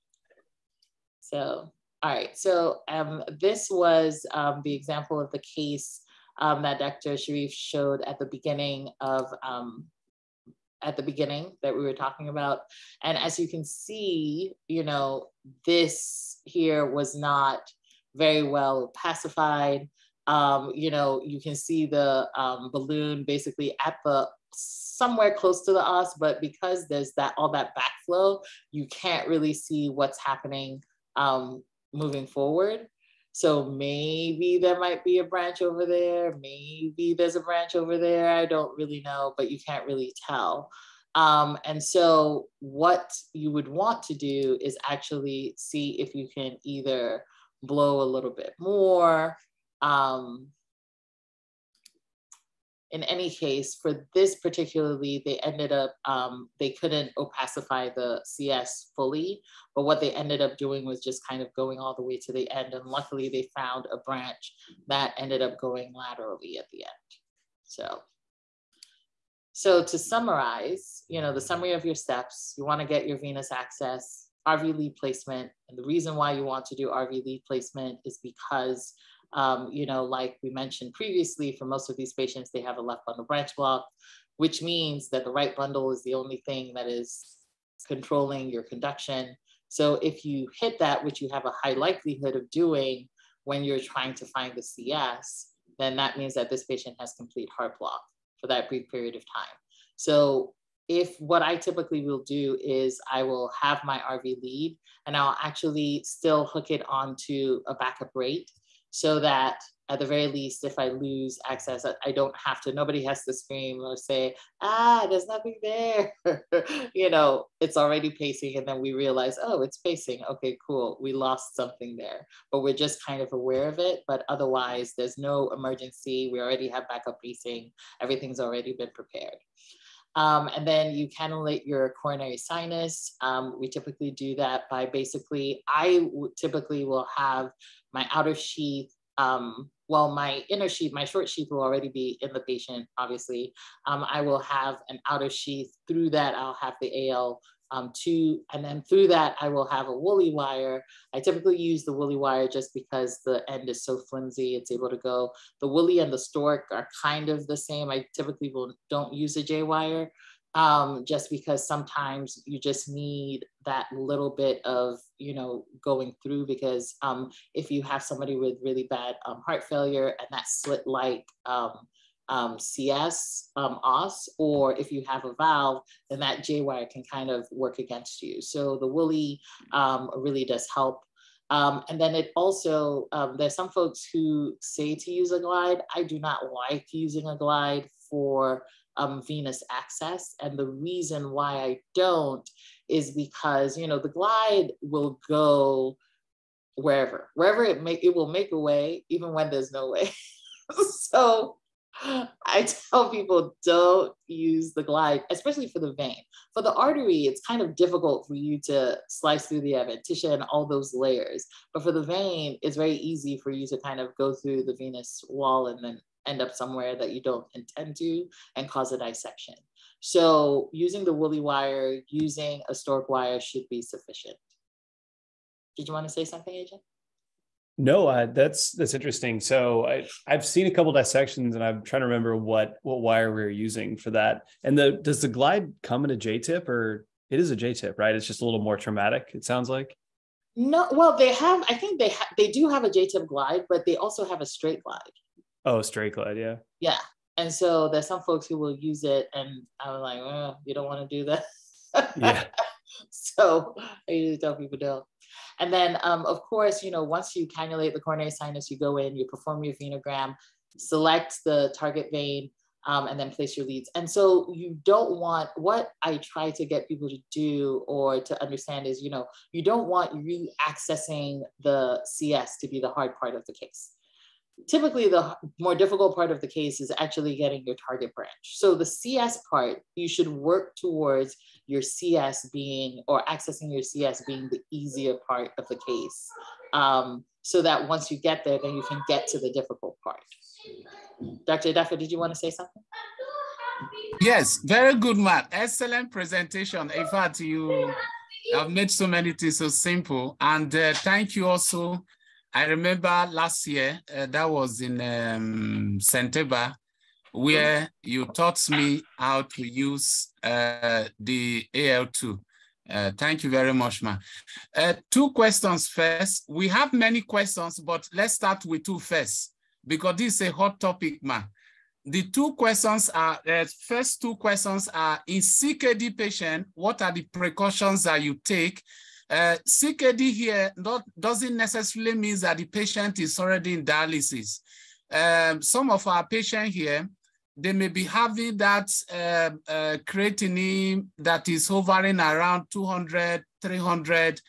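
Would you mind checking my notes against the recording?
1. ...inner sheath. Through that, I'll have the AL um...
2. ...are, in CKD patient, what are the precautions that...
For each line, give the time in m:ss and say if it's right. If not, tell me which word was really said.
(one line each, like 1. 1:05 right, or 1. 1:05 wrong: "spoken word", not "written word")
1. 2:25 wrong: "outer", not "inner"
2. 5:24 right.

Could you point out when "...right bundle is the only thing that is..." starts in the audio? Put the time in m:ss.
1:25.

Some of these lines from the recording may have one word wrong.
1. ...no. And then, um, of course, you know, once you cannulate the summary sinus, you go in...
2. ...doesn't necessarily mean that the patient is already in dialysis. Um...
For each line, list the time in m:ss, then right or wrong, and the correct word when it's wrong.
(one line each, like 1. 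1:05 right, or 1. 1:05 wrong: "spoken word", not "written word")
1. 4:14 wrong: "coronary", not "summary"
2. 5:31 right.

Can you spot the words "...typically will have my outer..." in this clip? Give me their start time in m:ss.
2:16.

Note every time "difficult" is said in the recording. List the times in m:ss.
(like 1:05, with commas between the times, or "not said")
3:27, 4:35, 4:49.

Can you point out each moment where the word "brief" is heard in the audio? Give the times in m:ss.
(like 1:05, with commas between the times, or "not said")
1:38.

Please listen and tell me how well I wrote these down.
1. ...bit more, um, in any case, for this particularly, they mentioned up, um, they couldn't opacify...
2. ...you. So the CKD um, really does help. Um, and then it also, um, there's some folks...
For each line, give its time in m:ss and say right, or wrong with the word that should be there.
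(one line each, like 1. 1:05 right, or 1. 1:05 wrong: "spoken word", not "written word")
1. 0:48 wrong: "ended", not "mentioned"
2. 2:58 wrong: "Wholey", not "CKD".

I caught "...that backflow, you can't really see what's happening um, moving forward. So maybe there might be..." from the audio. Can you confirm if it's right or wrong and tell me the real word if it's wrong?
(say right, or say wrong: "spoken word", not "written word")
right.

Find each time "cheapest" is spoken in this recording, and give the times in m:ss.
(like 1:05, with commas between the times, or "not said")
not said.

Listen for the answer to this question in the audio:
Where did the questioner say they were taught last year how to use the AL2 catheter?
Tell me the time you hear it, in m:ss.
5:05.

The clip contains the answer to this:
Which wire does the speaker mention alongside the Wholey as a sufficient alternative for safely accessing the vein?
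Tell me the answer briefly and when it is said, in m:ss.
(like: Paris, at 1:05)
Storq wire, at 3:42.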